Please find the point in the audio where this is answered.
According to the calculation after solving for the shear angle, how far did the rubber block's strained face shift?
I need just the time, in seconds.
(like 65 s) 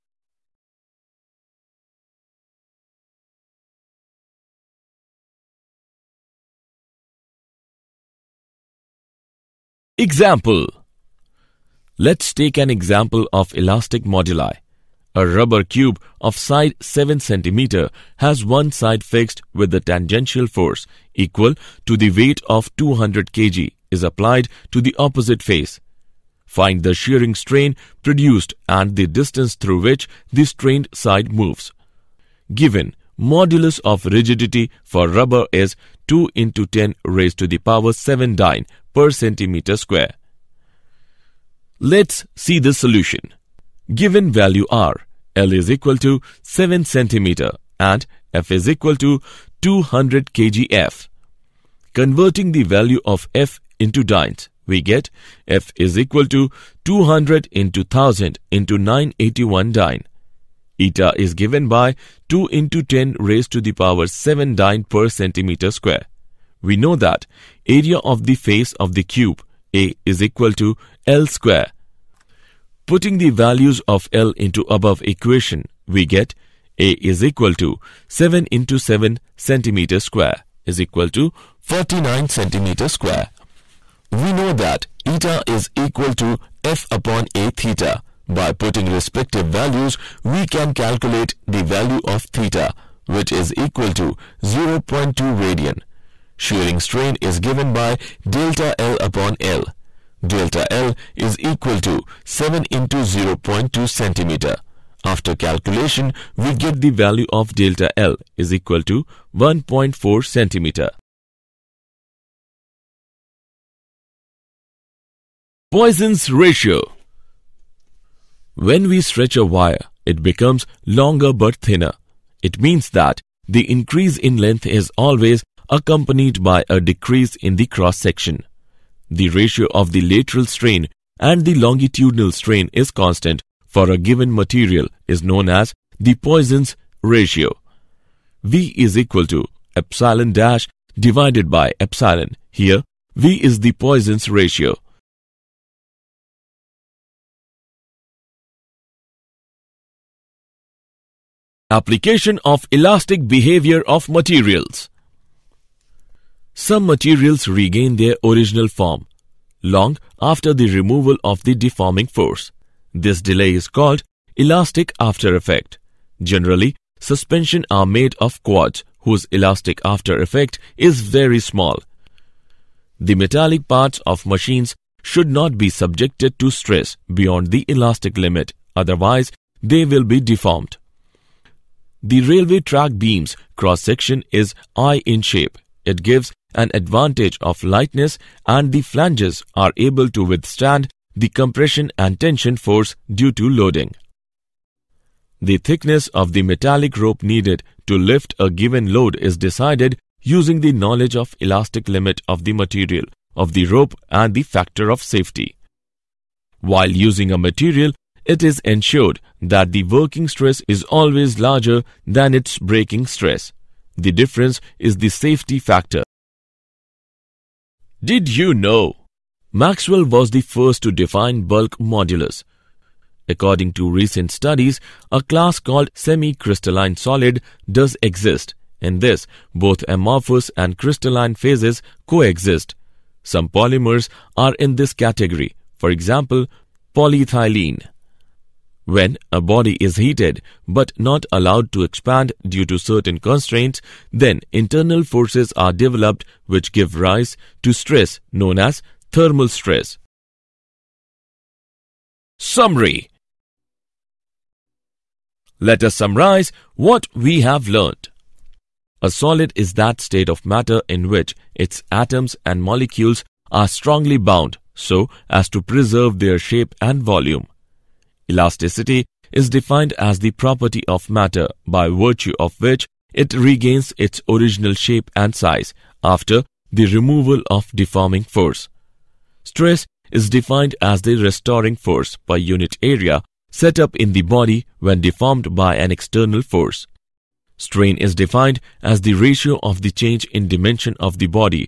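109 s.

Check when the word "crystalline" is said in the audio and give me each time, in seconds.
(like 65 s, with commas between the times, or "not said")
225 s, 230 s.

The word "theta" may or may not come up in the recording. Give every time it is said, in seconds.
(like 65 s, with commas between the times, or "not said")
87 s, 92 s.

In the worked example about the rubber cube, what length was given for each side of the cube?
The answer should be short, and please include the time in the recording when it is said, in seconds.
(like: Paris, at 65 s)
7 cm, at 16 s.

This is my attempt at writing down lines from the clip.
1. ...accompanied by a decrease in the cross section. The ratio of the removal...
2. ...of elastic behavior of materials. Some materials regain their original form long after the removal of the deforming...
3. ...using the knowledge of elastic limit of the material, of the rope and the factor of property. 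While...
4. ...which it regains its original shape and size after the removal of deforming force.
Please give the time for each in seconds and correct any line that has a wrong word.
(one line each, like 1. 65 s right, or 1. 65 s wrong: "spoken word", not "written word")
1. 125 s wrong: "lateral", not "removal"
2. 152 s right
3. 200 s wrong: "safety", not "property"
4. 272 s right.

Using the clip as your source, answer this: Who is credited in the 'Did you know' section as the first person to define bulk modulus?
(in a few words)
Maxwell.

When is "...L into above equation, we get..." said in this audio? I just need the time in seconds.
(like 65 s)
74 s.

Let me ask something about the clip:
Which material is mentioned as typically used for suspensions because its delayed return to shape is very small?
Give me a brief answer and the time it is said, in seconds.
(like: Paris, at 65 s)
quartz, at 168 s.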